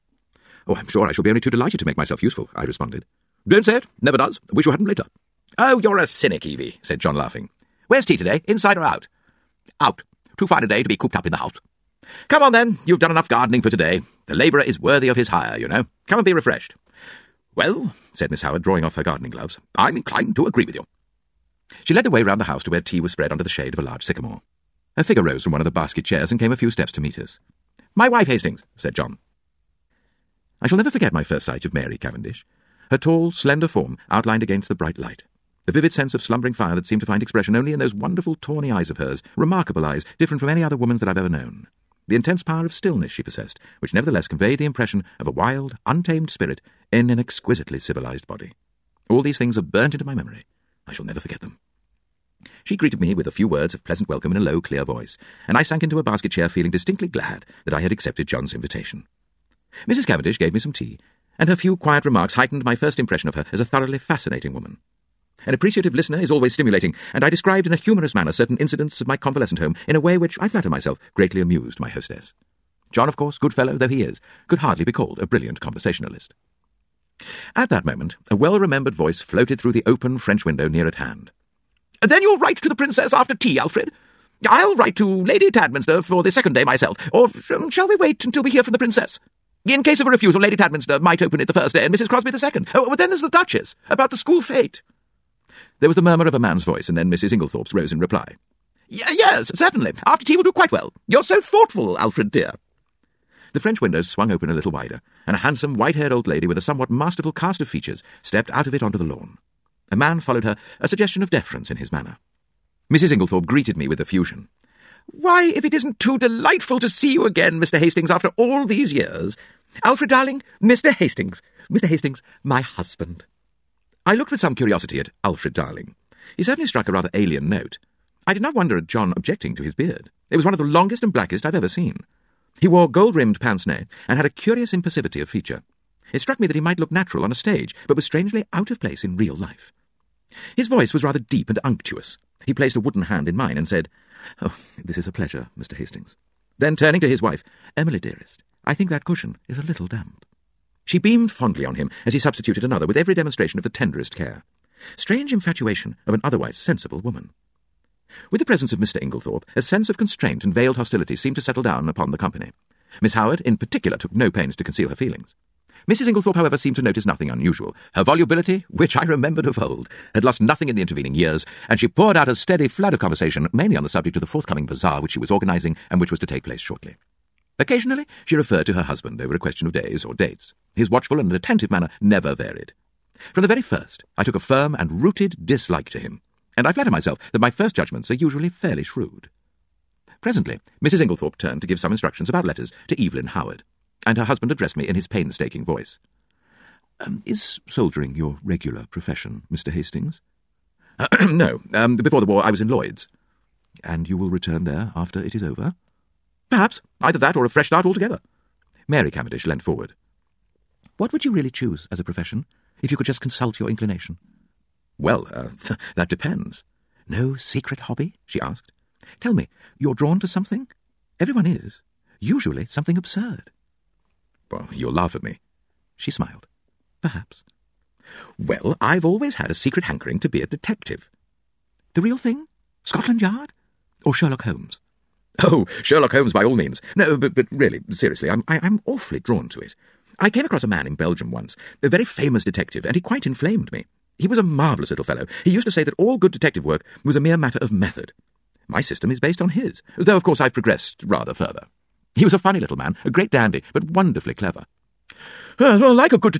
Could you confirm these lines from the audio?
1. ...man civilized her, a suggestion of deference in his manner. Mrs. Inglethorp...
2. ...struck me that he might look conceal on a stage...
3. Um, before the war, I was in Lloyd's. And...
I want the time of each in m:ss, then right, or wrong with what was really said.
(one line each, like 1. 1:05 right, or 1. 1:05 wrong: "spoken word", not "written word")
1. 1:49 wrong: "followed", not "civilized"
2. 2:16 wrong: "natural", not "conceal"
3. 3:21 right.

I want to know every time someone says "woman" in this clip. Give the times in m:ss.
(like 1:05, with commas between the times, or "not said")
0:40, 1:04, 2:36.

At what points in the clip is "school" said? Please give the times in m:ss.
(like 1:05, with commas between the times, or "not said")
1:34.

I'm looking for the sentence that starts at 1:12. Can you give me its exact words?
John, of course, good fellow though he is, could hardly be called a brilliant conversationalist.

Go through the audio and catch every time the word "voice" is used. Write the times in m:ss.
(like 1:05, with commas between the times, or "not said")
0:54, 1:18, 1:36, 2:20, 3:15.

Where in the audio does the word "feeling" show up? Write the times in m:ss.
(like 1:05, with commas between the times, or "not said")
0:56, 2:44.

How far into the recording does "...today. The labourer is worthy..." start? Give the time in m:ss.
0:13.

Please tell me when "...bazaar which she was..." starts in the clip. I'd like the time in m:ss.
2:54.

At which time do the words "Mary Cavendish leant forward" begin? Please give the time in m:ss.
3:28.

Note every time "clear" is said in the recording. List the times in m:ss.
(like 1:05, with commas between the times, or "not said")
0:54.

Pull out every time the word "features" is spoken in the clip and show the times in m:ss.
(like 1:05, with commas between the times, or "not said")
1:47, 2:15.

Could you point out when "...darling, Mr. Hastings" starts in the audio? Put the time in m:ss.
2:00.